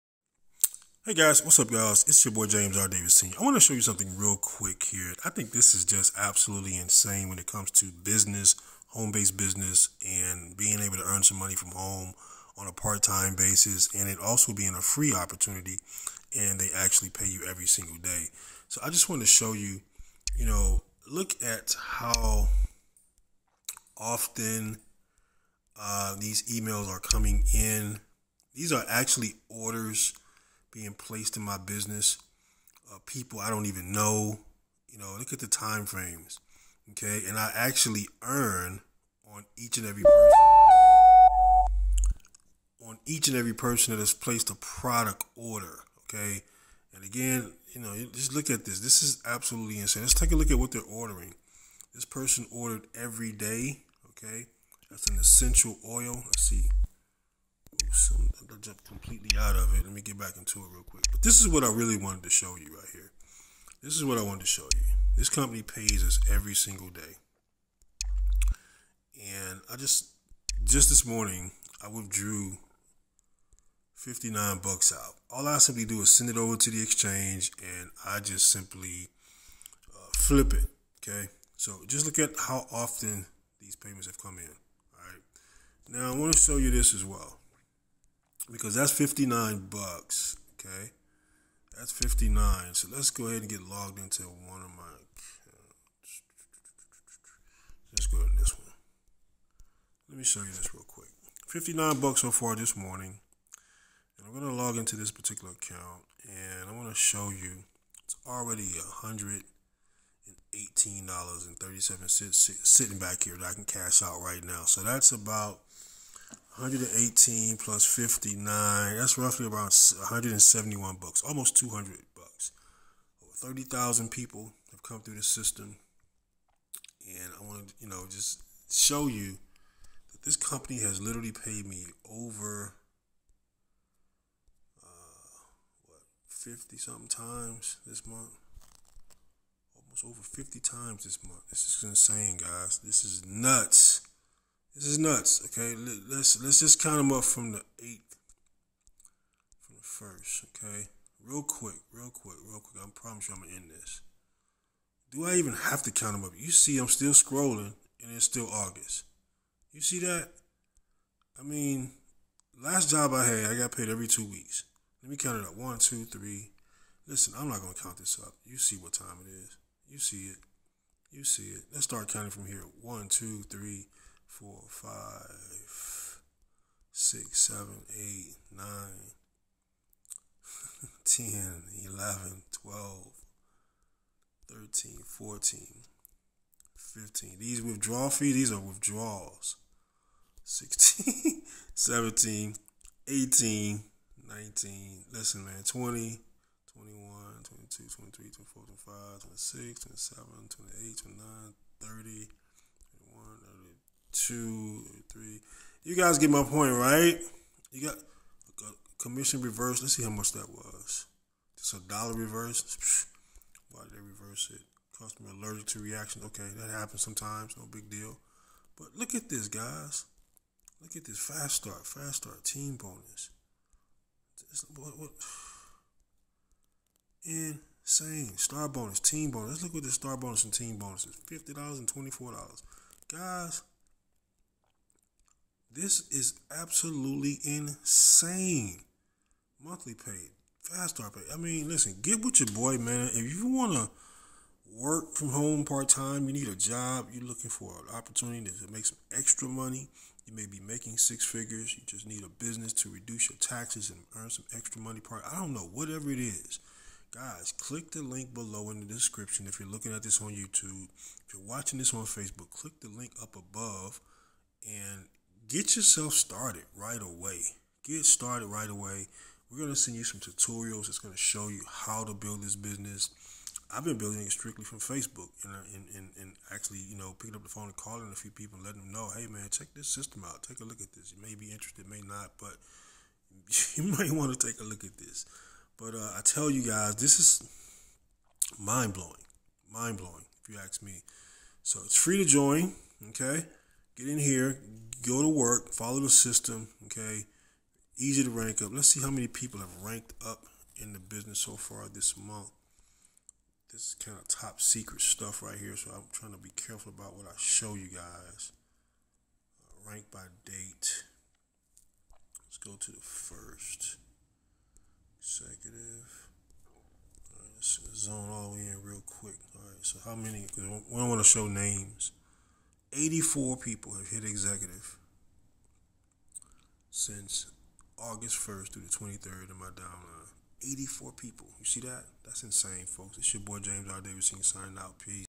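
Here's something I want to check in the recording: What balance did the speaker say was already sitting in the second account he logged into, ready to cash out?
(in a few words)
$118.37.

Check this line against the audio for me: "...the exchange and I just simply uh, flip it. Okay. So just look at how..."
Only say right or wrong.
right.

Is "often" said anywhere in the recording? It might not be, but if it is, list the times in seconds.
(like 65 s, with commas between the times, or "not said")
23 s, 82 s.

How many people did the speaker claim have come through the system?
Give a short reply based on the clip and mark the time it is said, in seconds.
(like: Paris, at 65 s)
30,000, at 123 s.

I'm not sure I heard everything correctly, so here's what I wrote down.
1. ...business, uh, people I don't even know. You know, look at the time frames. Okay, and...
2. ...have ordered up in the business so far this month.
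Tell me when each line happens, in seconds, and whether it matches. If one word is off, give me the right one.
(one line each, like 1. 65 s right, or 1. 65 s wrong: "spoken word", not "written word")
1. 31 s right
2. 299 s wrong: "ranked", not "ordered".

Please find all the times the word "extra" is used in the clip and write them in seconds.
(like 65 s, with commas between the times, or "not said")
249 s, 254 s.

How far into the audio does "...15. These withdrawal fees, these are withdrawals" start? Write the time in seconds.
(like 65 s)
187 s.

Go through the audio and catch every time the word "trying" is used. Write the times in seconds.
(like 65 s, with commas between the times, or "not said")
306 s.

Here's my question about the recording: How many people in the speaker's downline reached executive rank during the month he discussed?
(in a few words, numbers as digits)
84.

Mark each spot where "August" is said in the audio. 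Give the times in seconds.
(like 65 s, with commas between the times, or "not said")
158 s, 327 s.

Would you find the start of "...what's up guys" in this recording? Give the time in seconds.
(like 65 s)
1 s.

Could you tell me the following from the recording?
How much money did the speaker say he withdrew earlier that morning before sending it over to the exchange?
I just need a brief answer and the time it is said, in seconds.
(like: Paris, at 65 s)
$59, at 71 s.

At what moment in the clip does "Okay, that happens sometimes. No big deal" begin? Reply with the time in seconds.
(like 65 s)
216 s.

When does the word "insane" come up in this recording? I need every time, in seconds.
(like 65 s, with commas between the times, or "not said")
6 s, 49 s, 141 s, 227 s, 237 s, 332 s.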